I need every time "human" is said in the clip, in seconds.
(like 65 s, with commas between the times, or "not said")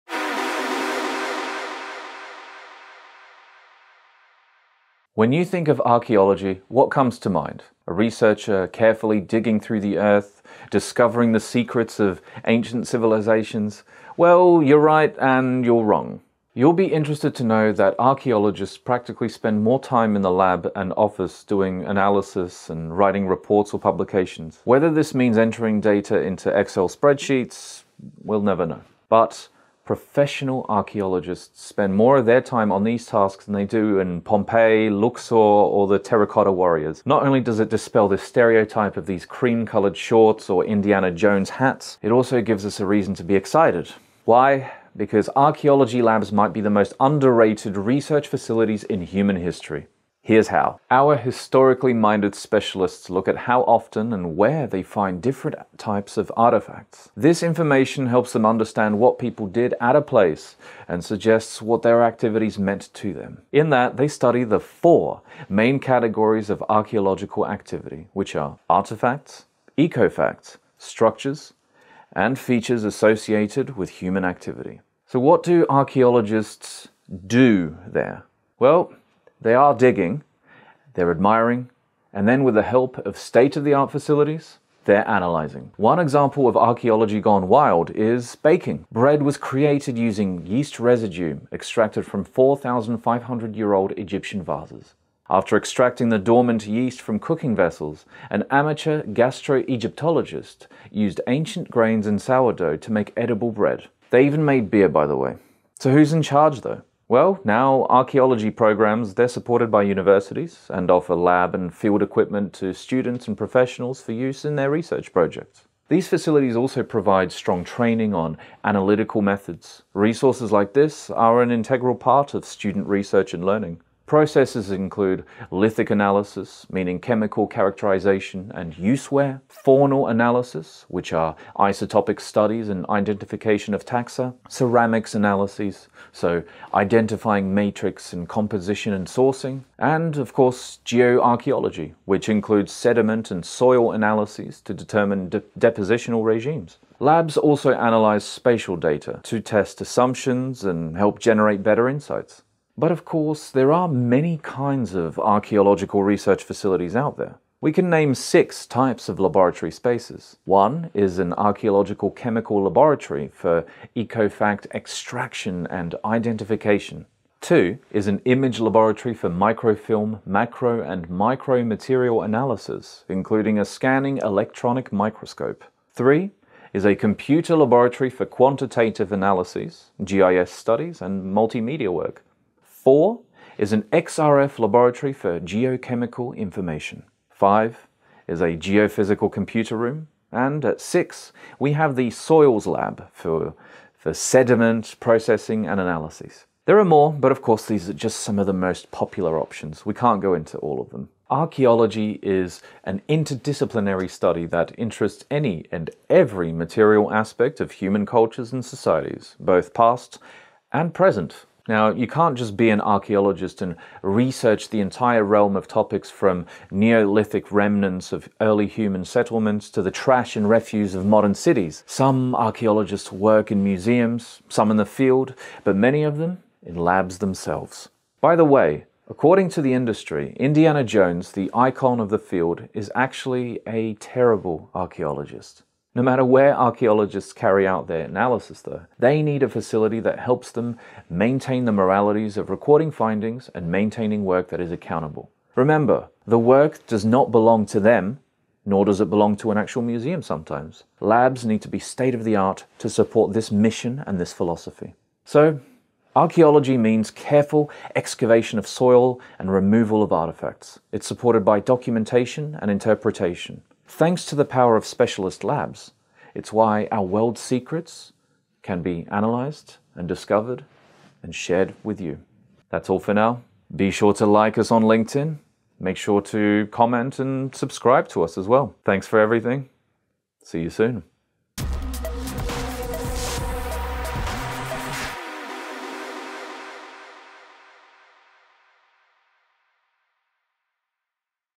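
49 s, 73 s, 207 s, 218 s.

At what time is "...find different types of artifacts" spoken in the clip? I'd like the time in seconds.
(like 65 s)
54 s.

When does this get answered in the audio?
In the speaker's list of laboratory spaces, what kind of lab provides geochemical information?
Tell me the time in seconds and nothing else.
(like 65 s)
183 s.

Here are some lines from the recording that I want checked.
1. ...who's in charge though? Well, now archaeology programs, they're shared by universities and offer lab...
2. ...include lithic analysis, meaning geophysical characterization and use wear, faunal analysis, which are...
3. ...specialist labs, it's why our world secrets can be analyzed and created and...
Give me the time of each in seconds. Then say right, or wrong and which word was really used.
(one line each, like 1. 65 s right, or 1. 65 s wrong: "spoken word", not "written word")
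1. 105 s wrong: "supported", not "shared"
2. 124 s wrong: "chemical", not "geophysical"
3. 264 s wrong: "discovered", not "created".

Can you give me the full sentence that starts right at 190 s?
And at six, we have the soils lab for, for sediment processing and analyses.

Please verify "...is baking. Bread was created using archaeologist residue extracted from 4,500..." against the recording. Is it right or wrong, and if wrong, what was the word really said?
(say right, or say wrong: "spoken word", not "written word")
wrong: "yeast", not "archaeologist".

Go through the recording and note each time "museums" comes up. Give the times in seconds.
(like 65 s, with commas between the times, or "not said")
223 s, 249 s.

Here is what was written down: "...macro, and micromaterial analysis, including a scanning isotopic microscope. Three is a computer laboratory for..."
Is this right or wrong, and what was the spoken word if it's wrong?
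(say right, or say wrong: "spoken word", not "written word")
wrong: "electronic", not "isotopic".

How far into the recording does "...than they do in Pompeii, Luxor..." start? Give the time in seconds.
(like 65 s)
33 s.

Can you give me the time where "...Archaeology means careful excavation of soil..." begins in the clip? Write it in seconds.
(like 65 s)
256 s.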